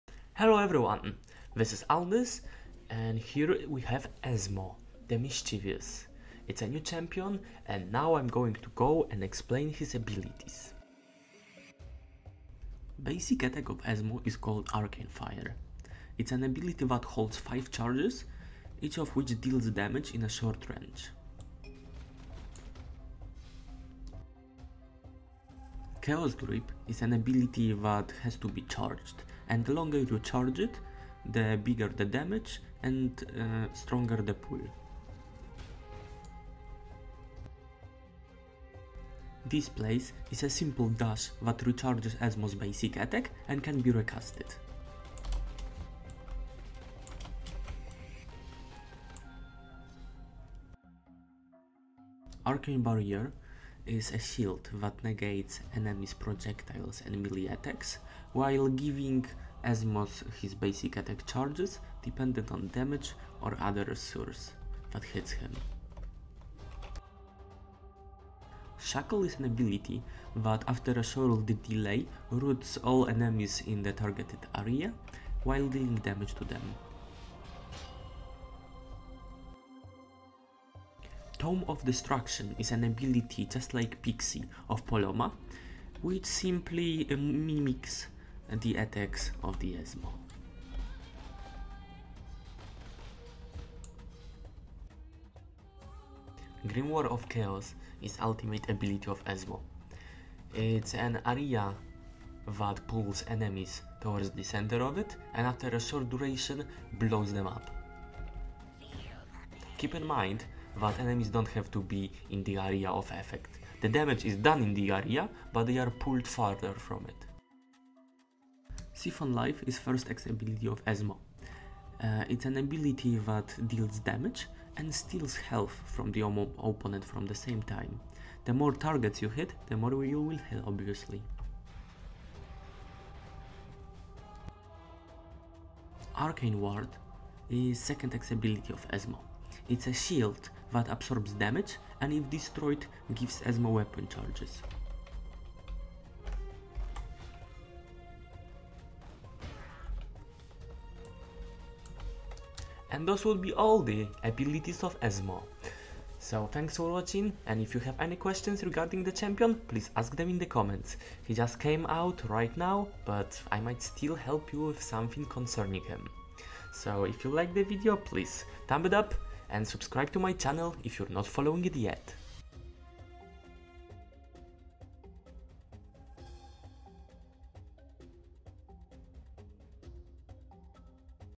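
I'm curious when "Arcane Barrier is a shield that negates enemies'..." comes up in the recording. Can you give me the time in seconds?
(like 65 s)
52 s.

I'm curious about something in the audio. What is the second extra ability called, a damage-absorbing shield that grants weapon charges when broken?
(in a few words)
Arcane Ward.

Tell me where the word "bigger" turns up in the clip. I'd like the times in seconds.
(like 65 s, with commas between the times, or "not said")
31 s.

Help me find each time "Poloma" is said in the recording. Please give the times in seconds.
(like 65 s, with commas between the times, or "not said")
84 s.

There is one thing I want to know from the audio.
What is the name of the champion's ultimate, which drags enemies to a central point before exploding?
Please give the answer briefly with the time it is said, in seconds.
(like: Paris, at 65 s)
Grim War of Chaos, at 96 s.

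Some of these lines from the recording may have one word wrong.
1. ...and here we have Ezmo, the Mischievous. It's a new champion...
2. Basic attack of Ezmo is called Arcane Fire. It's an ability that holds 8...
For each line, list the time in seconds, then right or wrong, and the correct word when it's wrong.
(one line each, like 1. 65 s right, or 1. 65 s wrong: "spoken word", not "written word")
1. 2 s right
2. 13 s wrong: "5", not "8".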